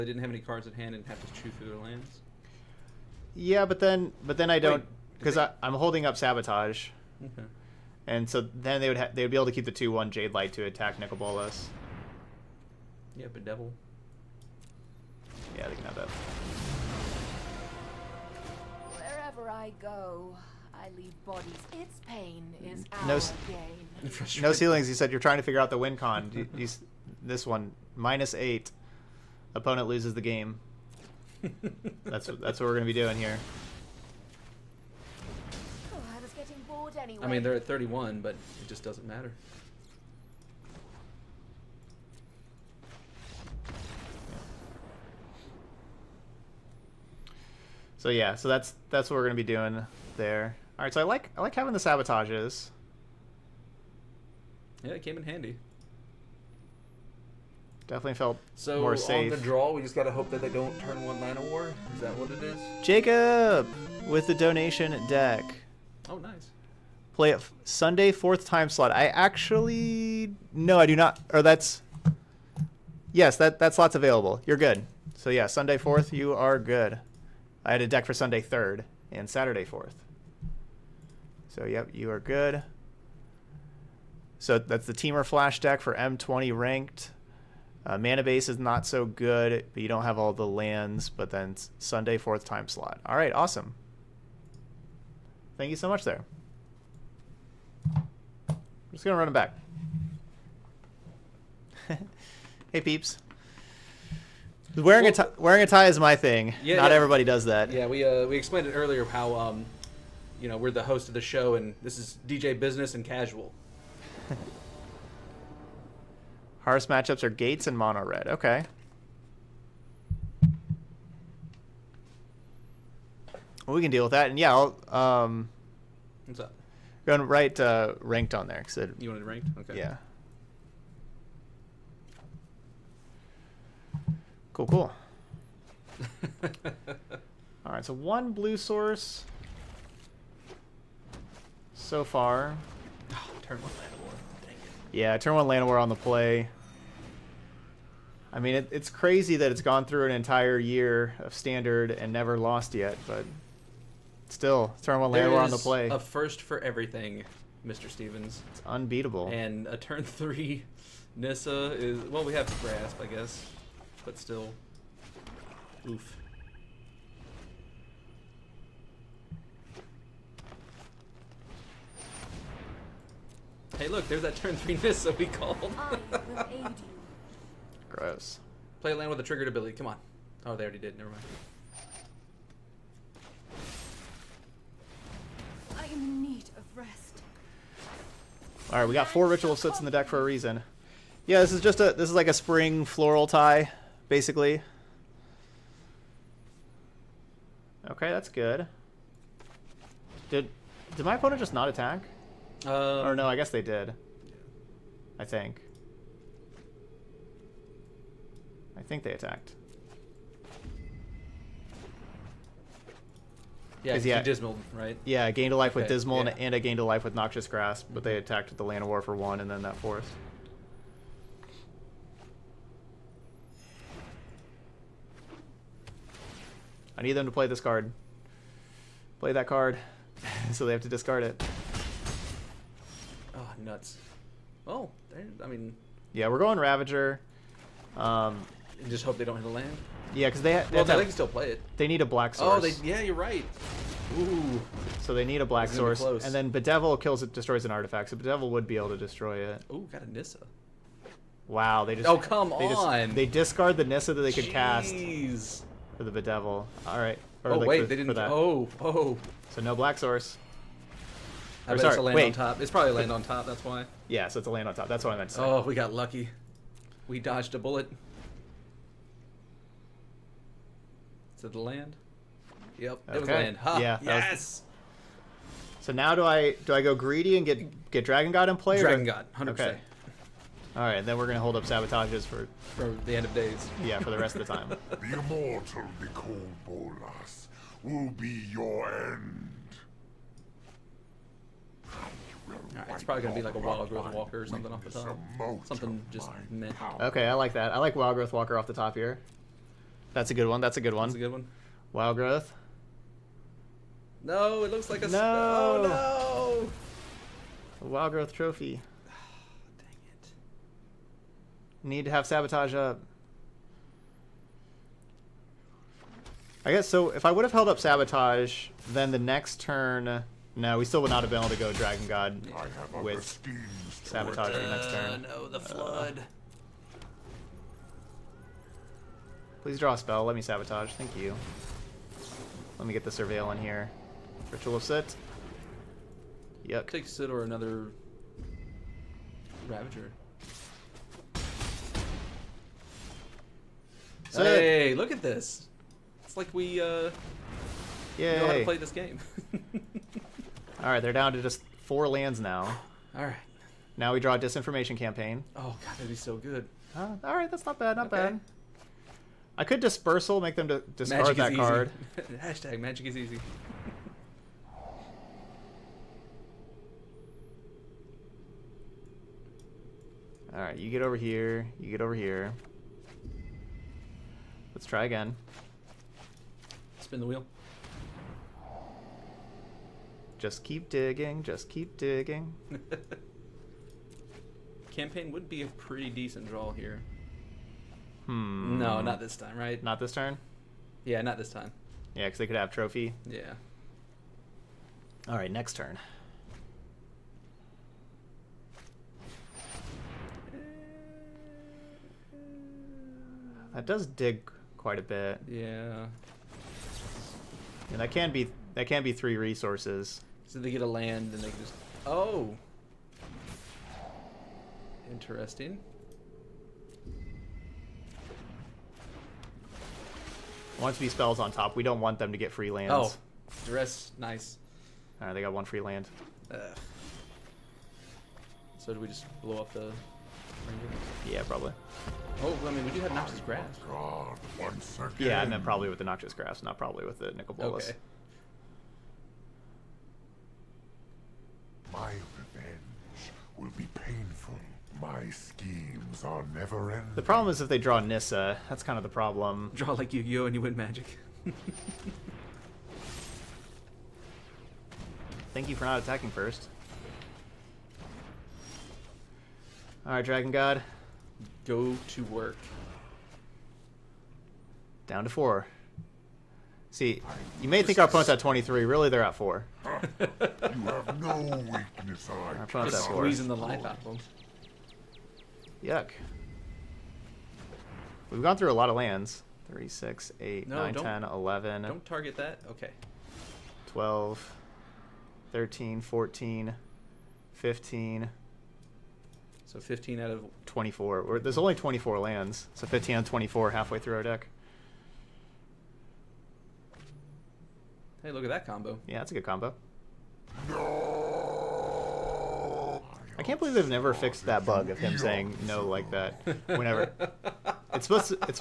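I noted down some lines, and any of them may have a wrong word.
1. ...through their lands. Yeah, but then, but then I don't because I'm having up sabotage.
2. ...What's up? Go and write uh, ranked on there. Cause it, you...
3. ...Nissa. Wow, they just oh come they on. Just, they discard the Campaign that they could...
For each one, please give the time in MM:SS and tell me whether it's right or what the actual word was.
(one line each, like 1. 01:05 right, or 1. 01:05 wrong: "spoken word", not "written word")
1. 00:01 wrong: "holding", not "having"
2. 02:06 right
3. 04:10 wrong: "Nissa", not "Campaign".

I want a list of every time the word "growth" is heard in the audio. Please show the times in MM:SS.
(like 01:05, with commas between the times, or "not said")
04:53, 04:58, 05:02, 05:08.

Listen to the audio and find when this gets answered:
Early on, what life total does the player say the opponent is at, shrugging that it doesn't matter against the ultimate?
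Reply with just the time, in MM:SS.
00:37.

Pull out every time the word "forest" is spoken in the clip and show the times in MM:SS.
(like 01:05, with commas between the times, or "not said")
03:39.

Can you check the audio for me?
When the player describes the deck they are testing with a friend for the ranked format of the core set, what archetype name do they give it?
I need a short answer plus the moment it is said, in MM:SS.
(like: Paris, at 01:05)
Temur Flash, at 01:24.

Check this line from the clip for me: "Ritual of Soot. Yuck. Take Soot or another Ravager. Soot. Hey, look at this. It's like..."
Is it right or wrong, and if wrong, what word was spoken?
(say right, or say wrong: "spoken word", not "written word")
right.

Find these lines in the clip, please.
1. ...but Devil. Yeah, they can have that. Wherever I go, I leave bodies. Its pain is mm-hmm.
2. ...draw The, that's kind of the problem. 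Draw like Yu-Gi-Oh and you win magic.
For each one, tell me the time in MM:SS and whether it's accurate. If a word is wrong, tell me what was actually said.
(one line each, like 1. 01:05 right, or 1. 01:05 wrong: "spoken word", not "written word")
1. 00:13 right
2. 07:27 wrong: "Nissa", not "The".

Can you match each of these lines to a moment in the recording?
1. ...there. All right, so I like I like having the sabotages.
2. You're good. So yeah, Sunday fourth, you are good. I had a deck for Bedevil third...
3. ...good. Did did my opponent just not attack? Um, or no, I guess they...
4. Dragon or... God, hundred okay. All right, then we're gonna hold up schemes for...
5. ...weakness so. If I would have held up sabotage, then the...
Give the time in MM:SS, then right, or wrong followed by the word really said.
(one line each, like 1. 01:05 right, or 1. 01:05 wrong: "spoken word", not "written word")
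1. 00:50 right
2. 01:14 wrong: "Sunday", not "Bedevil"
3. 03:18 right
4. 04:38 wrong: "sabotages", not "schemes"
5. 05:16 wrong: "guess", not "weakness".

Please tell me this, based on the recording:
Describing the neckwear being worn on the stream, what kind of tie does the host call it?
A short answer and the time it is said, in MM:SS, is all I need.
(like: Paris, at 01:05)
spring floral tie, at 03:12.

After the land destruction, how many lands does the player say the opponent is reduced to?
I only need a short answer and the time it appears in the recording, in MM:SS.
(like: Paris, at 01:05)
4, at 05:51.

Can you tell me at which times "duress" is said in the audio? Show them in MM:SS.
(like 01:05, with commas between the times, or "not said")
07:03.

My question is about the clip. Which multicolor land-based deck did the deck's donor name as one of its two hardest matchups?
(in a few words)
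Gates.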